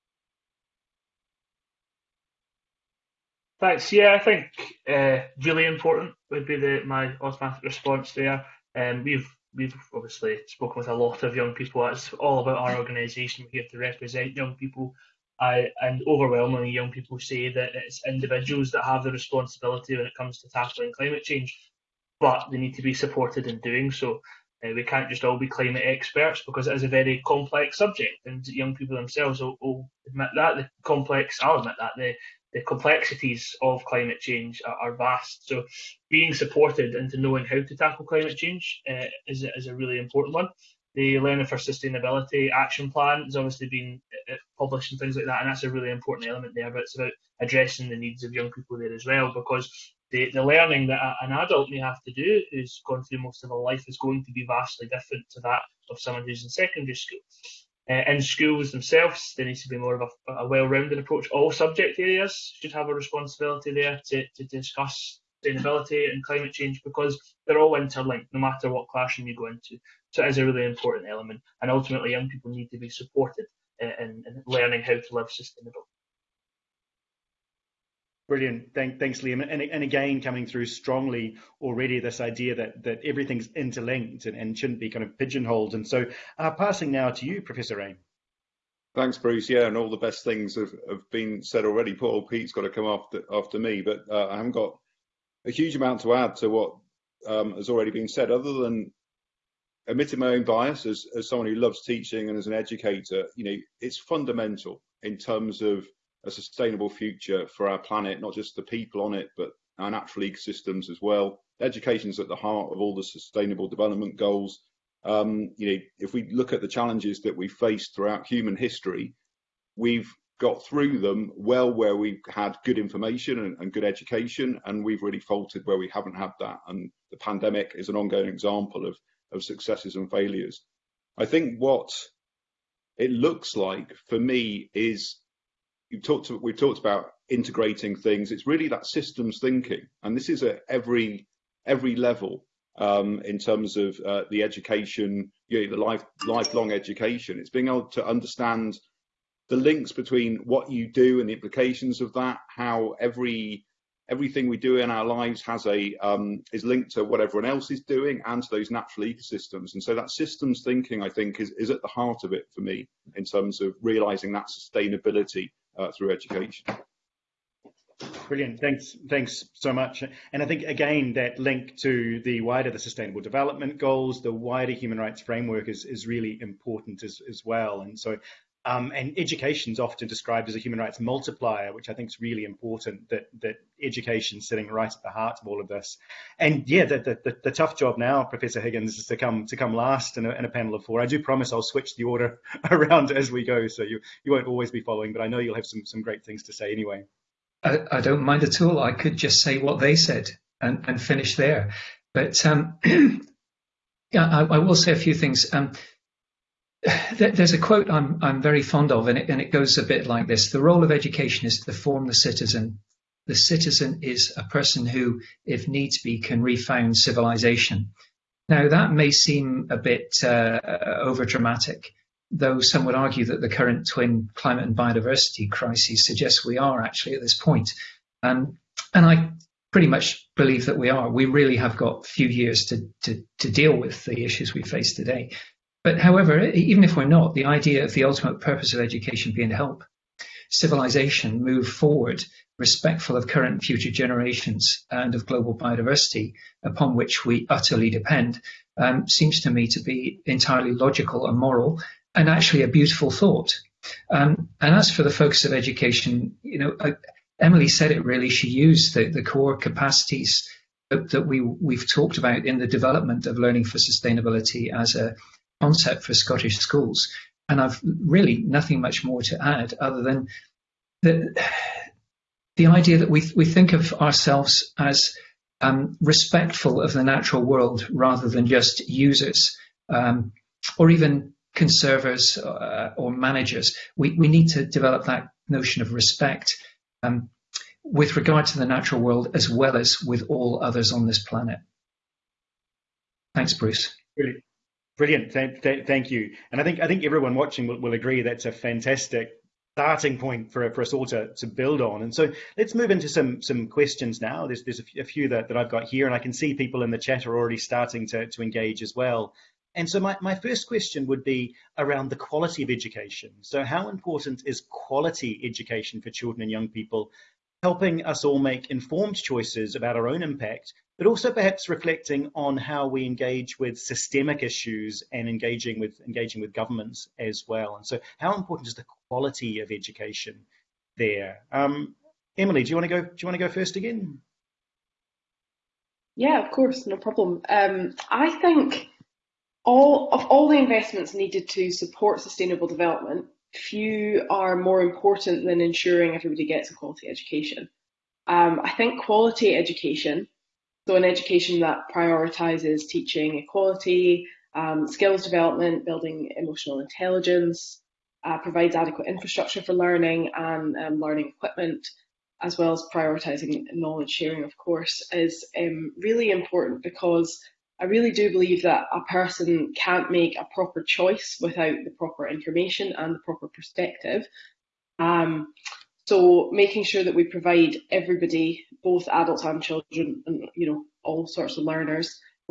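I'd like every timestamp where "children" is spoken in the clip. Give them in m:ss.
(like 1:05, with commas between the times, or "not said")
5:16, 6:19.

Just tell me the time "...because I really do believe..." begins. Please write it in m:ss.
6:06.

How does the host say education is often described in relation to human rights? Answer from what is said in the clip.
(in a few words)
A human rights multiplier.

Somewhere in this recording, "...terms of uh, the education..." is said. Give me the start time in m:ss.
2:23.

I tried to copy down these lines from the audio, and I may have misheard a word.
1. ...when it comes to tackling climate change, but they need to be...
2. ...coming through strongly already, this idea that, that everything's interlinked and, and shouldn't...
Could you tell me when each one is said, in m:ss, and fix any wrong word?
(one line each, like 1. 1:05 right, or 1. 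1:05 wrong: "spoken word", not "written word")
1. 0:19 right
2. 1:20 right.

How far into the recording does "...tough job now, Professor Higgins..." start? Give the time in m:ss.
3:07.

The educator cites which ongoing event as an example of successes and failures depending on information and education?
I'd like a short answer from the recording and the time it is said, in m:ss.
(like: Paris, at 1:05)
The pandemic, at 2:07.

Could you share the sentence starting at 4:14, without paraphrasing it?
Um, and as for the focus of education, you know, uh, Emily said it really.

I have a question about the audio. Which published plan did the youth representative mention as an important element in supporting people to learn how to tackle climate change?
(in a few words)
Learning for Sustainability Action Plan.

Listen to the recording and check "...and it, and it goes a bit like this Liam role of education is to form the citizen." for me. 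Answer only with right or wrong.
wrong.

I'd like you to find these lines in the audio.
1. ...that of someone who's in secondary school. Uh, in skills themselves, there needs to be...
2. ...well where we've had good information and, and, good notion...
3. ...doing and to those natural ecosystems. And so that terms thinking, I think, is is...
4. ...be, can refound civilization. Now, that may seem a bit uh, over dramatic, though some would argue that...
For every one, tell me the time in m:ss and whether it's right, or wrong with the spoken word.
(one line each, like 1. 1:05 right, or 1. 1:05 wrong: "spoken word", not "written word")
1. 0:55 wrong: "schools", not "skills"
2. 2:01 wrong: "education", not "notion"
3. 2:37 wrong: "systems", not "terms"
4. 3:36 right.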